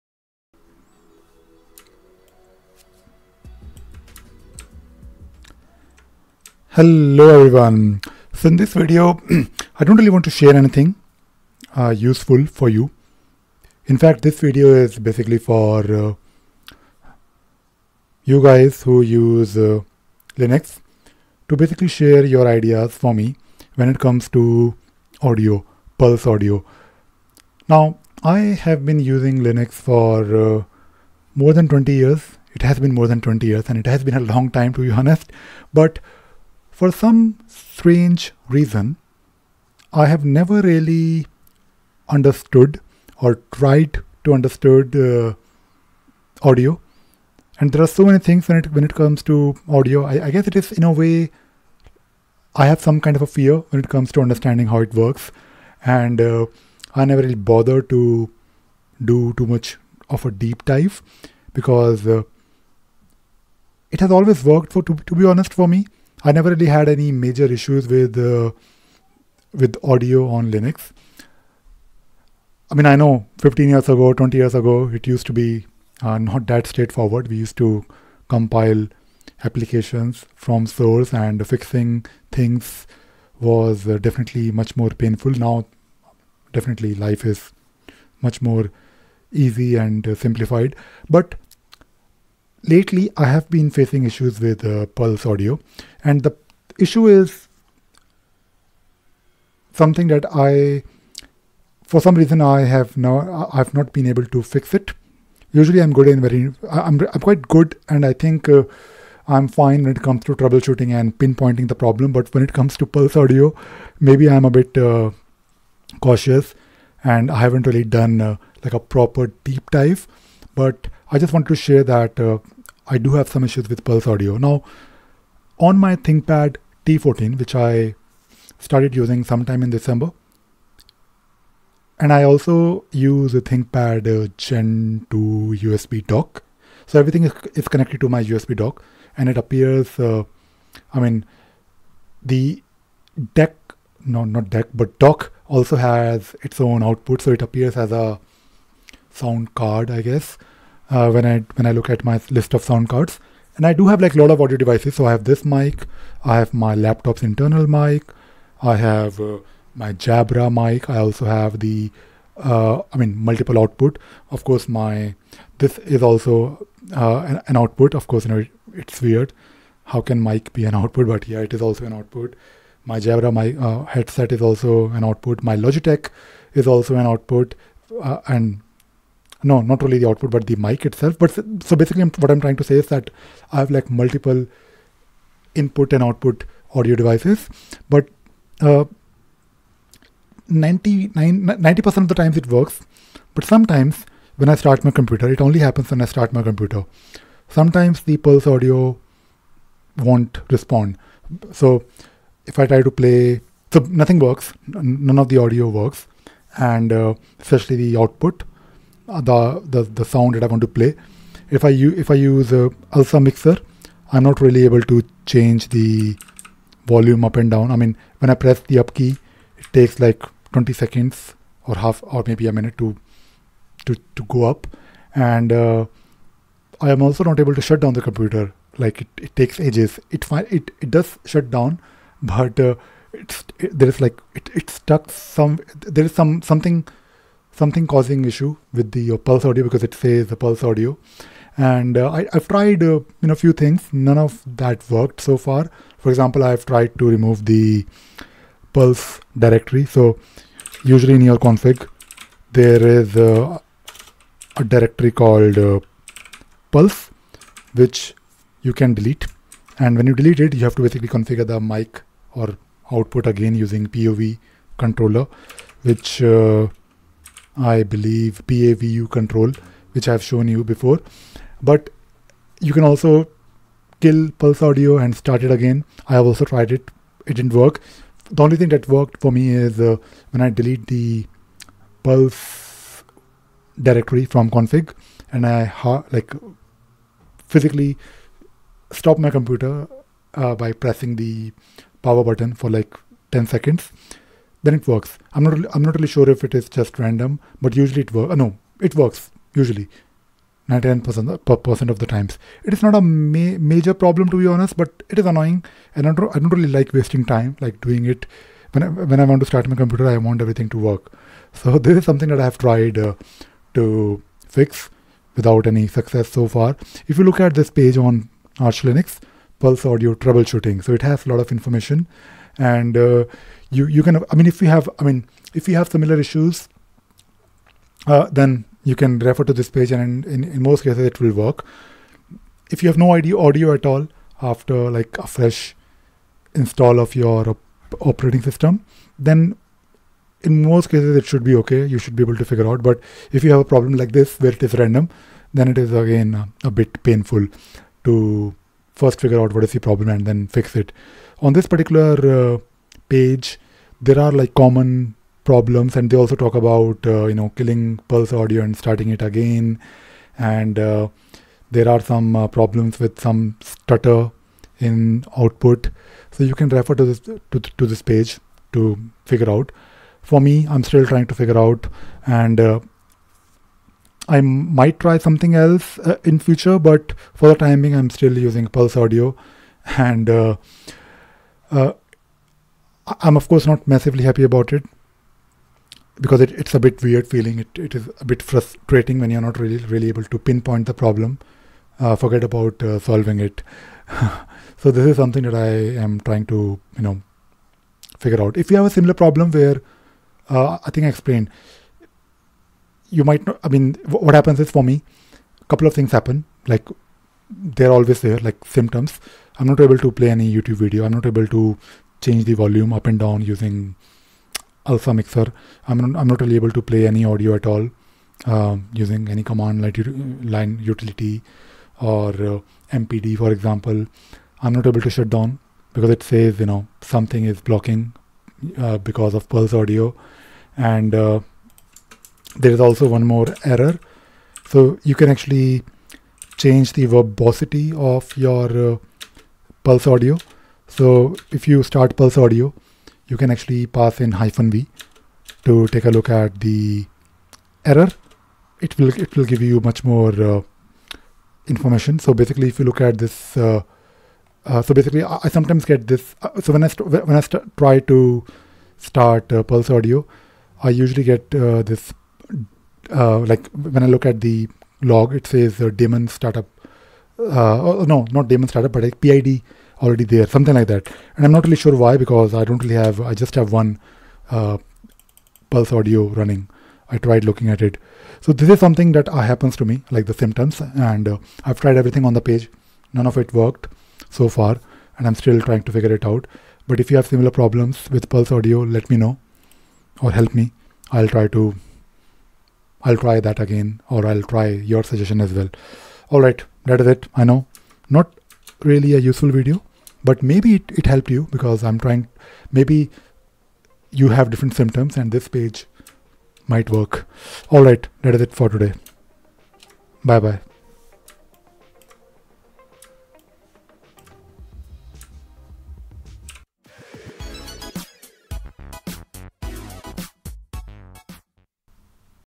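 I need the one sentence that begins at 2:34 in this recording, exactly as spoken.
So I have this mic, I have my laptop's internal mic, I have uh, my Jabra mic.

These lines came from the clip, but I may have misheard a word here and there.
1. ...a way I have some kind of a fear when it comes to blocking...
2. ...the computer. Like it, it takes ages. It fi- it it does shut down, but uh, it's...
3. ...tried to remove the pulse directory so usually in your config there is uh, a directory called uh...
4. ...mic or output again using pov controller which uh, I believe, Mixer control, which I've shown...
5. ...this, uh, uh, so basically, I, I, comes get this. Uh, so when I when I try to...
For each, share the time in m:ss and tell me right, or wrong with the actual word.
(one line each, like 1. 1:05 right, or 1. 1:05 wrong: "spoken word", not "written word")
1. 0:50 wrong: "understanding", not "blocking"
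2. 3:47 right
3. 4:06 right
4. 4:21 wrong: "PAVU", not "Mixer"
5. 7:33 wrong: "sometimes", not "comes".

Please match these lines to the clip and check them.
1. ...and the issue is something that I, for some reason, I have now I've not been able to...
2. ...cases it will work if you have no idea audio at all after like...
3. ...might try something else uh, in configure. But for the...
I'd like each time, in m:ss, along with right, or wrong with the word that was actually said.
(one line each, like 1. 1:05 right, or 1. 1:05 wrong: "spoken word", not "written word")
1. 1:36 right
2. 5:30 right
3. 6:14 wrong: "future", not "configure".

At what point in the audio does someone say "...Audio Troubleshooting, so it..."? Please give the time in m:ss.
5:19.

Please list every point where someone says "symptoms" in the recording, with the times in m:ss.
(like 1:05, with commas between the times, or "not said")
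6:48, 8:00, 8:24.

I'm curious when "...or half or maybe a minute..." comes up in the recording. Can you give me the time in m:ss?
3:41.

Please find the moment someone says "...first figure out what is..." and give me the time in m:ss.
5:48.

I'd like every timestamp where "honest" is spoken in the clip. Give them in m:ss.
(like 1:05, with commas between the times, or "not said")
0:34, 1:05, 5:04.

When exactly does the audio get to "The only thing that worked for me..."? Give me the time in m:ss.
4:38.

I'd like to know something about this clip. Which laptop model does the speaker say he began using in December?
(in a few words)
ThinkPad T14.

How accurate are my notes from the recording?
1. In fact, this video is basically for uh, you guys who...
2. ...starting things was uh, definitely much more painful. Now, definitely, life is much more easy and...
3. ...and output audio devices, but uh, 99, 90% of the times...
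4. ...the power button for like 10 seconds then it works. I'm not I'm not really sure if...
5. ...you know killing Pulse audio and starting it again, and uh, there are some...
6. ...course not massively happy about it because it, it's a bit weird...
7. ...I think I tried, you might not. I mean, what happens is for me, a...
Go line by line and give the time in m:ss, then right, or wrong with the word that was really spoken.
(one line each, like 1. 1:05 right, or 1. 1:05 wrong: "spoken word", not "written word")
1. 0:13 right
2. 1:21 wrong: "fixing", not "starting"
3. 3:05 right
4. 4:51 right
5. 5:57 right
6. 6:23 right
7. 6:40 wrong: "explained", not "tried".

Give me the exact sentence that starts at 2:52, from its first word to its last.
My Jabra my uh, headset is also an output.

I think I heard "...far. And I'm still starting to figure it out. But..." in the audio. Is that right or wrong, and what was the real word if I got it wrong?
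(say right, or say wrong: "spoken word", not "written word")
wrong: "trying", not "starting".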